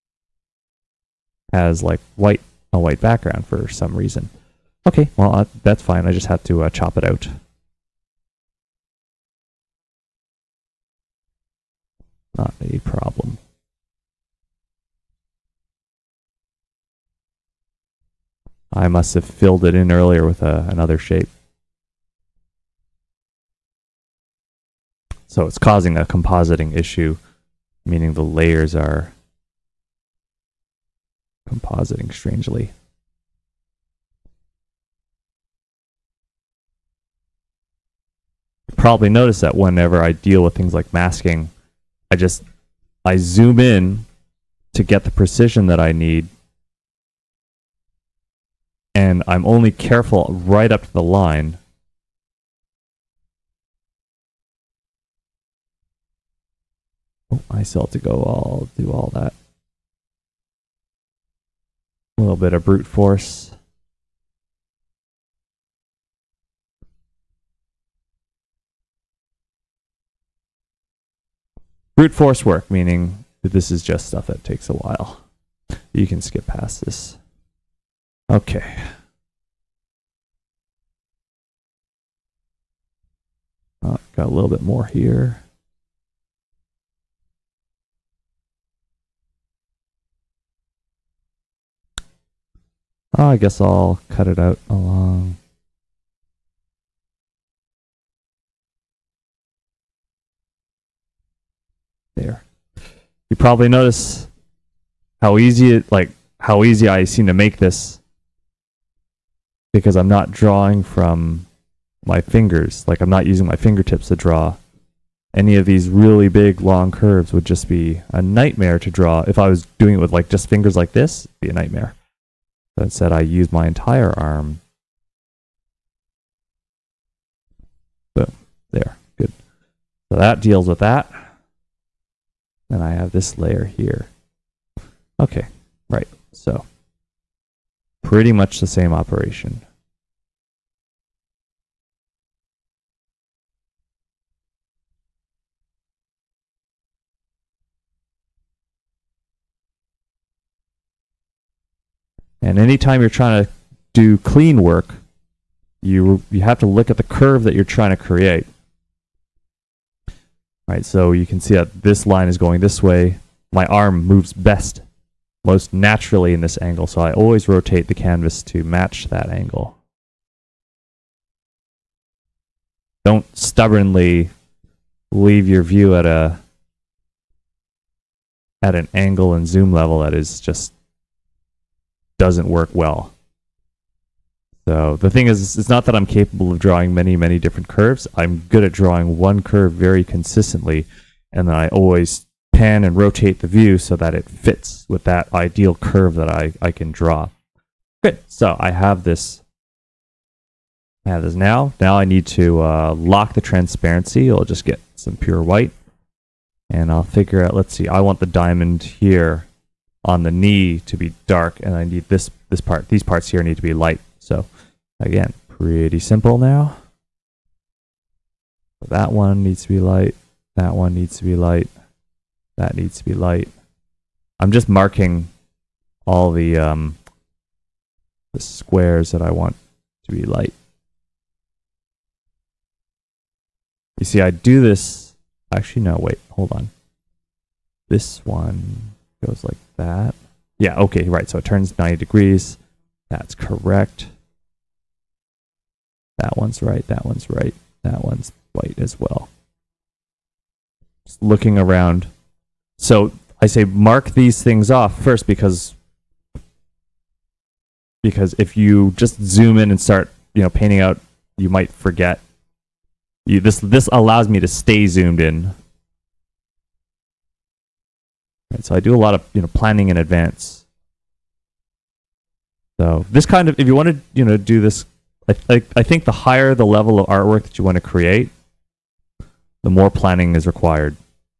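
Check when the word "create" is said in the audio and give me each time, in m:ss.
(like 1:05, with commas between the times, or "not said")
2:37, 4:37.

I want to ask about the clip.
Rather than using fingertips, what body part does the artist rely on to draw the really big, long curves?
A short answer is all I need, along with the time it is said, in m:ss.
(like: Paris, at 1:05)
entire arm, at 2:03.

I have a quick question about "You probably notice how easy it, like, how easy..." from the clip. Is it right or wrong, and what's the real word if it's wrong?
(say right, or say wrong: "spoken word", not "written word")
right.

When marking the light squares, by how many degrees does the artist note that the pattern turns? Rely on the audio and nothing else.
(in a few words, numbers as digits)
90.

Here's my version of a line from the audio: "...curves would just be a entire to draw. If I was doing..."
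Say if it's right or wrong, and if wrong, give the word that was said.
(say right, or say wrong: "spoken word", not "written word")
wrong: "nightmare", not "entire".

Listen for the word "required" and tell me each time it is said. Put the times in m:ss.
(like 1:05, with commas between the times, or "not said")
4:40.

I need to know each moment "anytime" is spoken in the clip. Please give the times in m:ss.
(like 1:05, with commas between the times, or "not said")
2:32.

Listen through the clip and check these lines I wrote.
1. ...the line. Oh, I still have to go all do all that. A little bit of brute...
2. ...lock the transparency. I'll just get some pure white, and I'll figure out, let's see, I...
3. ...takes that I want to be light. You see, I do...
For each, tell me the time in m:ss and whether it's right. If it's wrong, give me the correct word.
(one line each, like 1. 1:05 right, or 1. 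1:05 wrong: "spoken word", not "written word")
1. 0:50 right
2. 3:22 right
3. 3:48 wrong: "squares", not "takes".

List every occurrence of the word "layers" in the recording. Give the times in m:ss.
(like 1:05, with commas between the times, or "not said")
0:28, 2:13.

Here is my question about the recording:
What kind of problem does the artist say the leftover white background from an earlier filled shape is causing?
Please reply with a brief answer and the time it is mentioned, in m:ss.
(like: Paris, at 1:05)
compositing issue, at 0:26.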